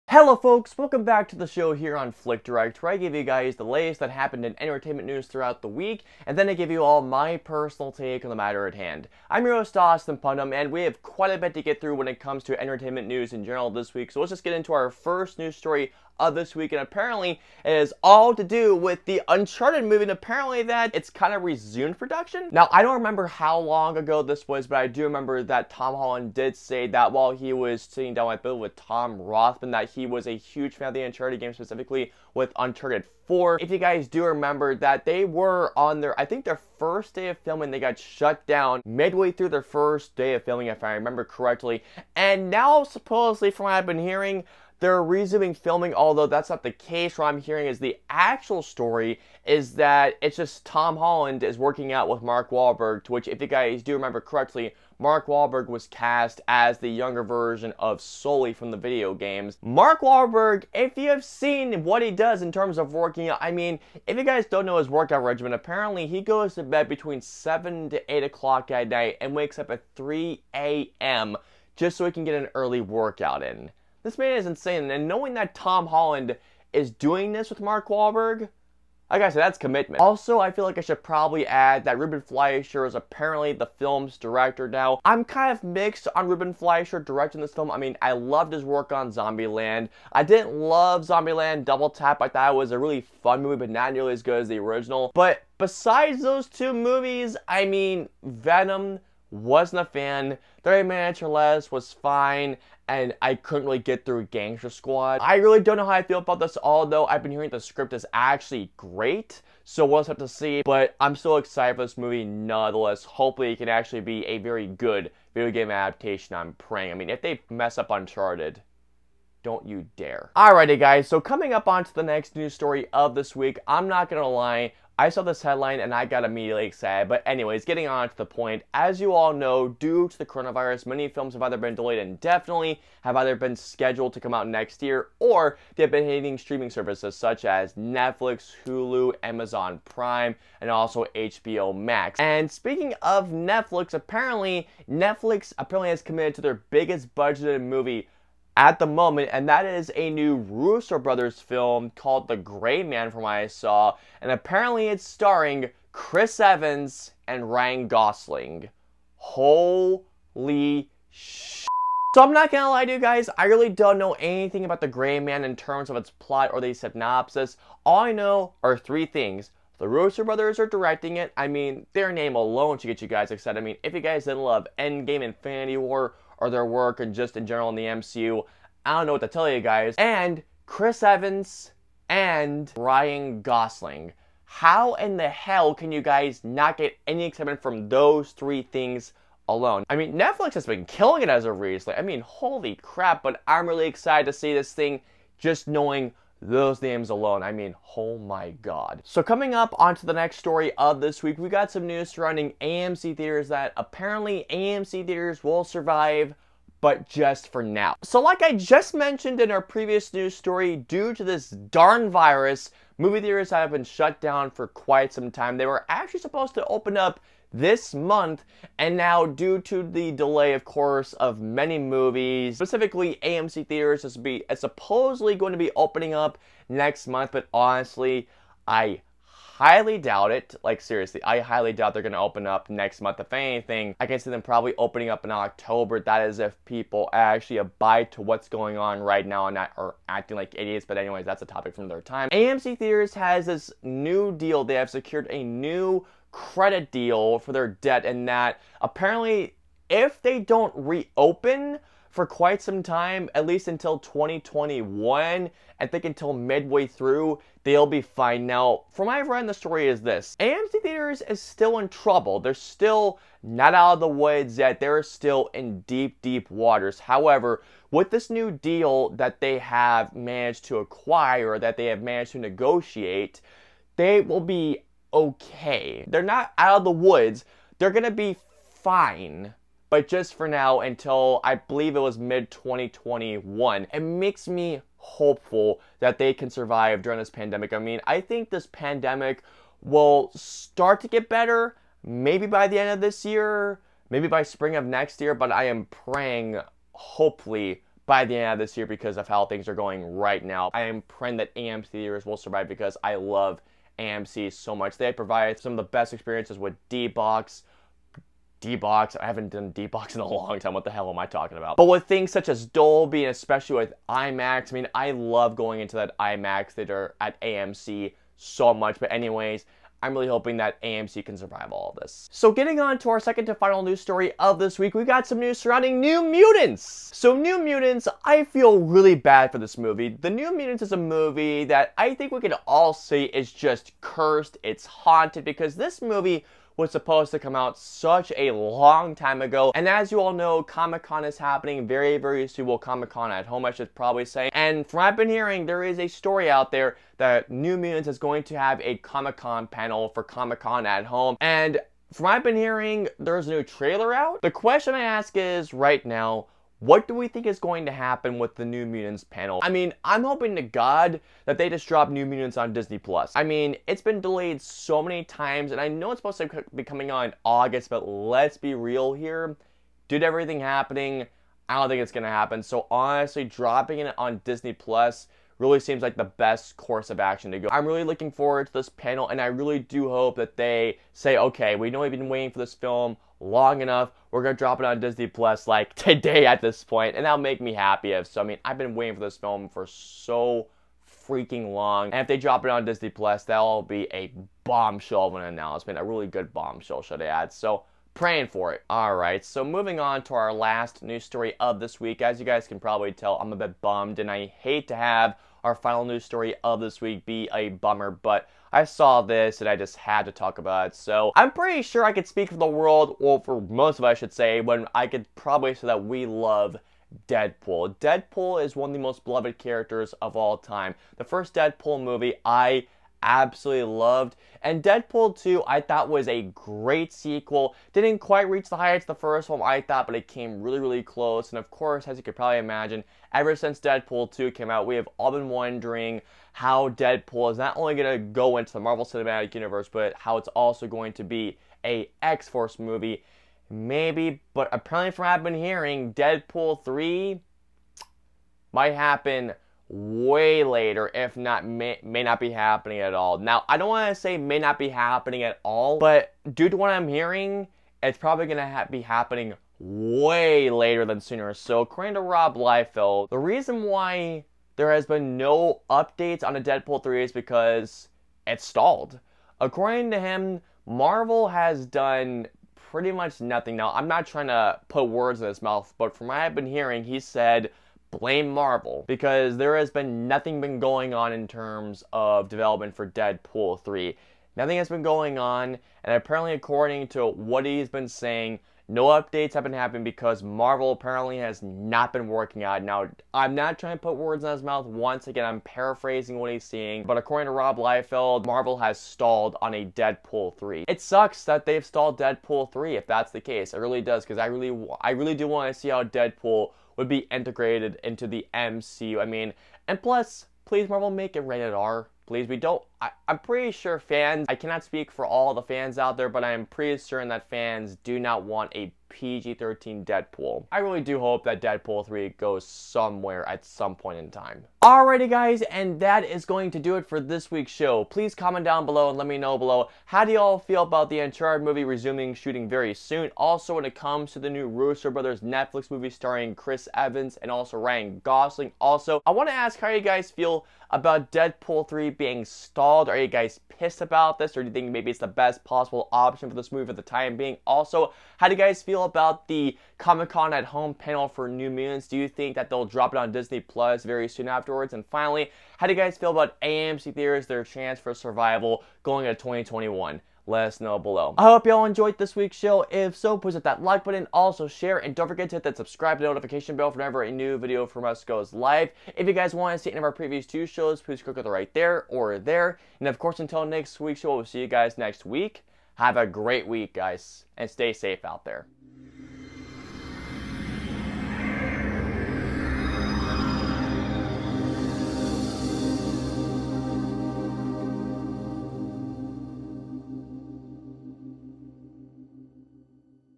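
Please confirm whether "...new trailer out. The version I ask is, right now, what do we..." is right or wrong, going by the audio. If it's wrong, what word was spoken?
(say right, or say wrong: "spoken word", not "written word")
wrong: "question", not "version".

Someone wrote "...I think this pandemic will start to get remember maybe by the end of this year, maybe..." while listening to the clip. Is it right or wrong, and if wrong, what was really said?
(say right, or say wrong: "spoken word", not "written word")
wrong: "better", not "remember".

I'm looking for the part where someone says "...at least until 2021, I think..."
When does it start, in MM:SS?
04:13.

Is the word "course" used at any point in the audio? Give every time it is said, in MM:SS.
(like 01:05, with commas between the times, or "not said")
03:40, 06:16, 07:11, 09:33.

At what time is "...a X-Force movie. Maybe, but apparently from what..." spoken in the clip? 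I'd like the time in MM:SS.
07:21.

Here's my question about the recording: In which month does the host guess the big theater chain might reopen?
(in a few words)
October.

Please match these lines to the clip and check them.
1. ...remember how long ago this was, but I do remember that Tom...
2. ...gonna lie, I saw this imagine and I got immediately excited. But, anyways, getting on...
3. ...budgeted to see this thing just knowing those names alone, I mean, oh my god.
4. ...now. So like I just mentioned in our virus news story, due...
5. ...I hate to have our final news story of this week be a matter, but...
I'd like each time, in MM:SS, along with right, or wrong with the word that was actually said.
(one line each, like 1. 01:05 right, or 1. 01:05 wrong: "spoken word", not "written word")
1. 00:22 right
2. 02:04 wrong: "headline", not "imagine"
3. 03:13 wrong: "excited", not "budgeted"
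4. 03:27 wrong: "previous", not "virus"
5. 06:44 wrong: "bummer", not "matter".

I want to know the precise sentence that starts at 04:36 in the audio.
They're not out of the woods.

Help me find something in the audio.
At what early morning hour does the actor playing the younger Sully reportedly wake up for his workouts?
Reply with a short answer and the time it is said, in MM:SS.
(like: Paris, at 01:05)
3 a.m., at 01:09.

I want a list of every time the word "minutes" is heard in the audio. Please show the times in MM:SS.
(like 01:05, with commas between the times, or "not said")
01:40.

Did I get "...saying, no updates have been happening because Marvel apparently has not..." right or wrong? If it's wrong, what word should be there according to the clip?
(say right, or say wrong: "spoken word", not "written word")
right.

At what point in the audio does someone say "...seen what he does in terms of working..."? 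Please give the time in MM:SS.
01:01.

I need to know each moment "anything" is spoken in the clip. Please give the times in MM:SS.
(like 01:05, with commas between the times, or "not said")
02:44, 03:53.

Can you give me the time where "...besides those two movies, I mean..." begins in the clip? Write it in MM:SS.
01:35.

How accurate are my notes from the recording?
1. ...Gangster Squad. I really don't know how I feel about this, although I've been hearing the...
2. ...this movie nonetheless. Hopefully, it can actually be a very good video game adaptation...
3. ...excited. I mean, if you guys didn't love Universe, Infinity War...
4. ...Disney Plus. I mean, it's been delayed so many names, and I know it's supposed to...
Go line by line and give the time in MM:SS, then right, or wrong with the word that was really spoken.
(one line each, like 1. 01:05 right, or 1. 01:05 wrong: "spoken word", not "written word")
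1. 01:44 right
2. 01:51 right
3. 02:53 wrong: "Endgame", not "Universe"
4. 06:02 wrong: "times", not "names".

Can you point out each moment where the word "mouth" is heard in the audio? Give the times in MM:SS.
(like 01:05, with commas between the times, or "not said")
07:55, 08:14.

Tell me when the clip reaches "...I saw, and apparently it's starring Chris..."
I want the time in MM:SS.
02:33.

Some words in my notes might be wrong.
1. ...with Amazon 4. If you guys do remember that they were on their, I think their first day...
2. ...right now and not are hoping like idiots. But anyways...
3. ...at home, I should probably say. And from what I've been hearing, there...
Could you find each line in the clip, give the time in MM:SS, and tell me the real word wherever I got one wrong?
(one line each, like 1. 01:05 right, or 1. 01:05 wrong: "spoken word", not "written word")
1. 00:32 wrong: "Uncharted", not "Amazon"
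2. 03:58 wrong: "acting", not "hoping"
3. 05:43 right.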